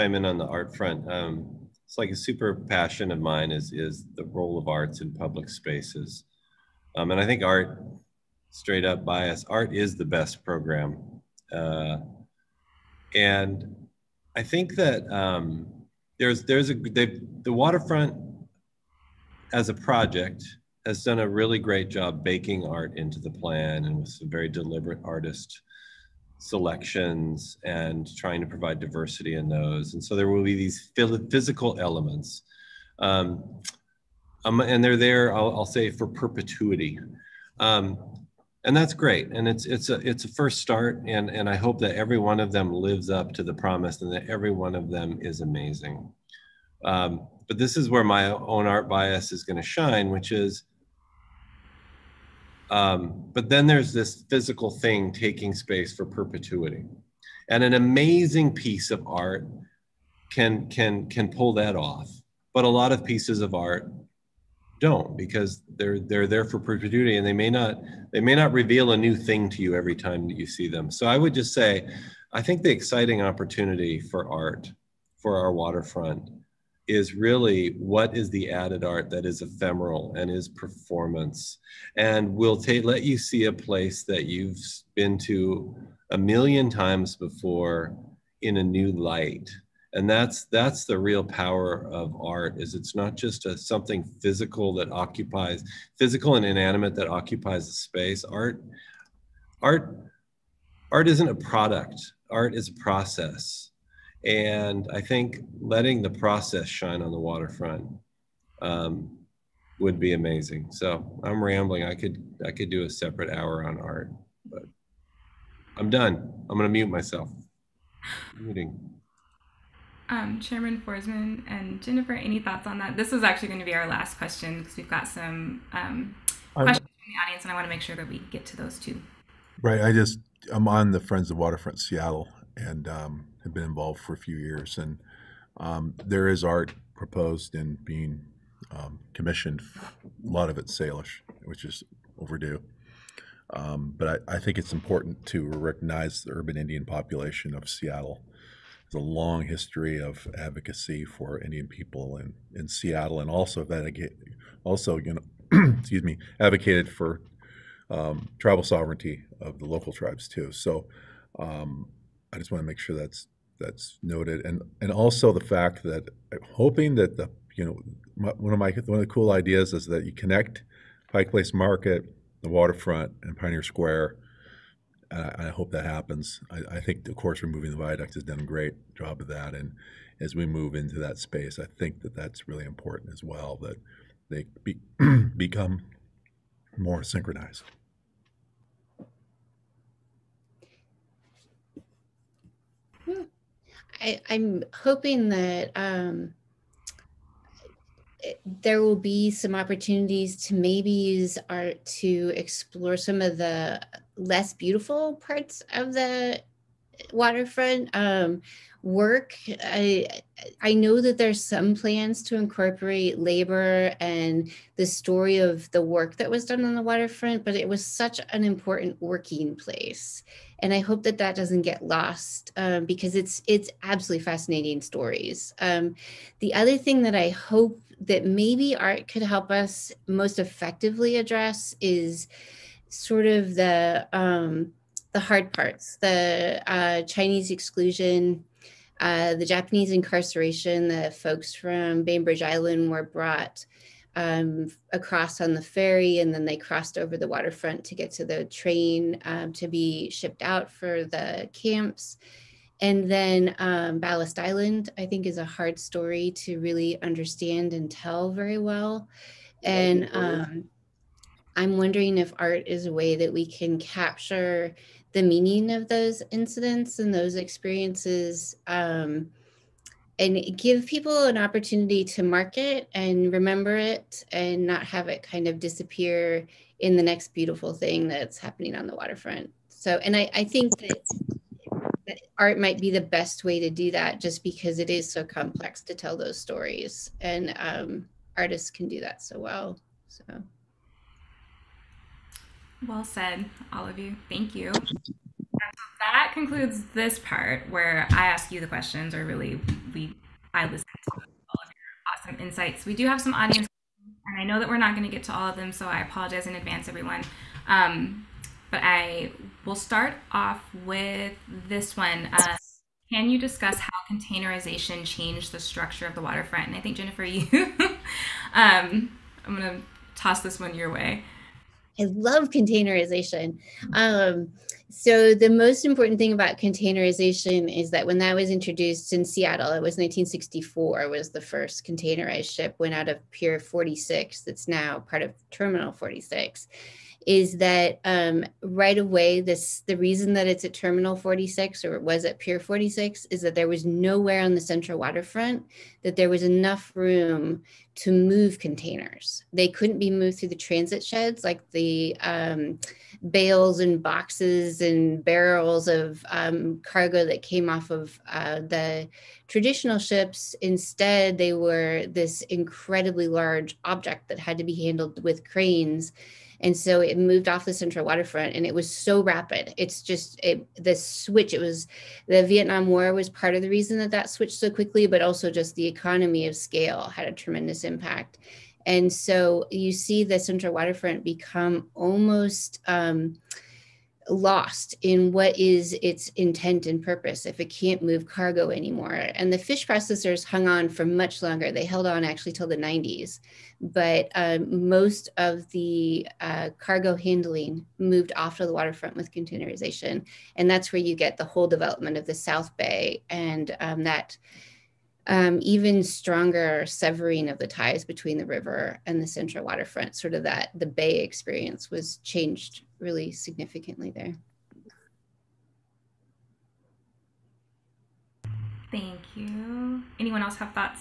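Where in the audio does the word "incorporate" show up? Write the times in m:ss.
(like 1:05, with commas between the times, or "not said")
3:32.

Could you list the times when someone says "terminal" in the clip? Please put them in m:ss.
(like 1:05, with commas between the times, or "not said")
5:35, 5:40.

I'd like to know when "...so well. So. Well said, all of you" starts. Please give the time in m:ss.
4:49.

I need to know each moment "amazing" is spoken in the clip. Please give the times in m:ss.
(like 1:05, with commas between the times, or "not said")
0:45, 0:57, 1:50.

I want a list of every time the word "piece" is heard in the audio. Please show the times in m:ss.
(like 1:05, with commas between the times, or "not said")
0:58, 1:03.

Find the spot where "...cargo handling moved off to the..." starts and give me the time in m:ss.
6:36.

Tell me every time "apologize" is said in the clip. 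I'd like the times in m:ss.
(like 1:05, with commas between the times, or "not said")
5:06.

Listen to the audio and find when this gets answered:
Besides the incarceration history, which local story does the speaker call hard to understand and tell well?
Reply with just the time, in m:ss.
4:13.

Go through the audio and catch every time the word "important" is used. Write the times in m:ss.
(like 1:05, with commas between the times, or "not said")
2:24, 3:02, 3:38, 5:25.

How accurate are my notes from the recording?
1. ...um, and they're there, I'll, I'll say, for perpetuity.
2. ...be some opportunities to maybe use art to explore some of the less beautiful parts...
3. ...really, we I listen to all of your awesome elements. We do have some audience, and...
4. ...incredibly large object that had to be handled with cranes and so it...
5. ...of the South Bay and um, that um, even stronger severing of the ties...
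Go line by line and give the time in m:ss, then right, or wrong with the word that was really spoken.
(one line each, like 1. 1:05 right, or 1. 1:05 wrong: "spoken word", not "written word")
1. 0:34 right
2. 3:18 right
3. 4:59 wrong: "insights", not "elements"
4. 6:02 right
5. 6:42 right.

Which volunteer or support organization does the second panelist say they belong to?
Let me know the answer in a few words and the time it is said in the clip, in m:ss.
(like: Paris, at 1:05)
Friends of Waterfront Seattle, at 2:10.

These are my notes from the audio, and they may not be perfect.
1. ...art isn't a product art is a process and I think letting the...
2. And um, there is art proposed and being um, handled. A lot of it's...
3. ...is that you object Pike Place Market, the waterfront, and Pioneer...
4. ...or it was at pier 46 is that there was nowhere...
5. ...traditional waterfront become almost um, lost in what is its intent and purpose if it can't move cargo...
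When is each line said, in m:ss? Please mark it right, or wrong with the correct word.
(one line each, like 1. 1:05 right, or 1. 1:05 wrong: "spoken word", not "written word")
1. 1:40 right
2. 2:14 wrong: "commissioned", not "handled"
3. 2:49 wrong: "connect", not "object"
4. 5:41 right
5. 6:20 wrong: "central", not "traditional".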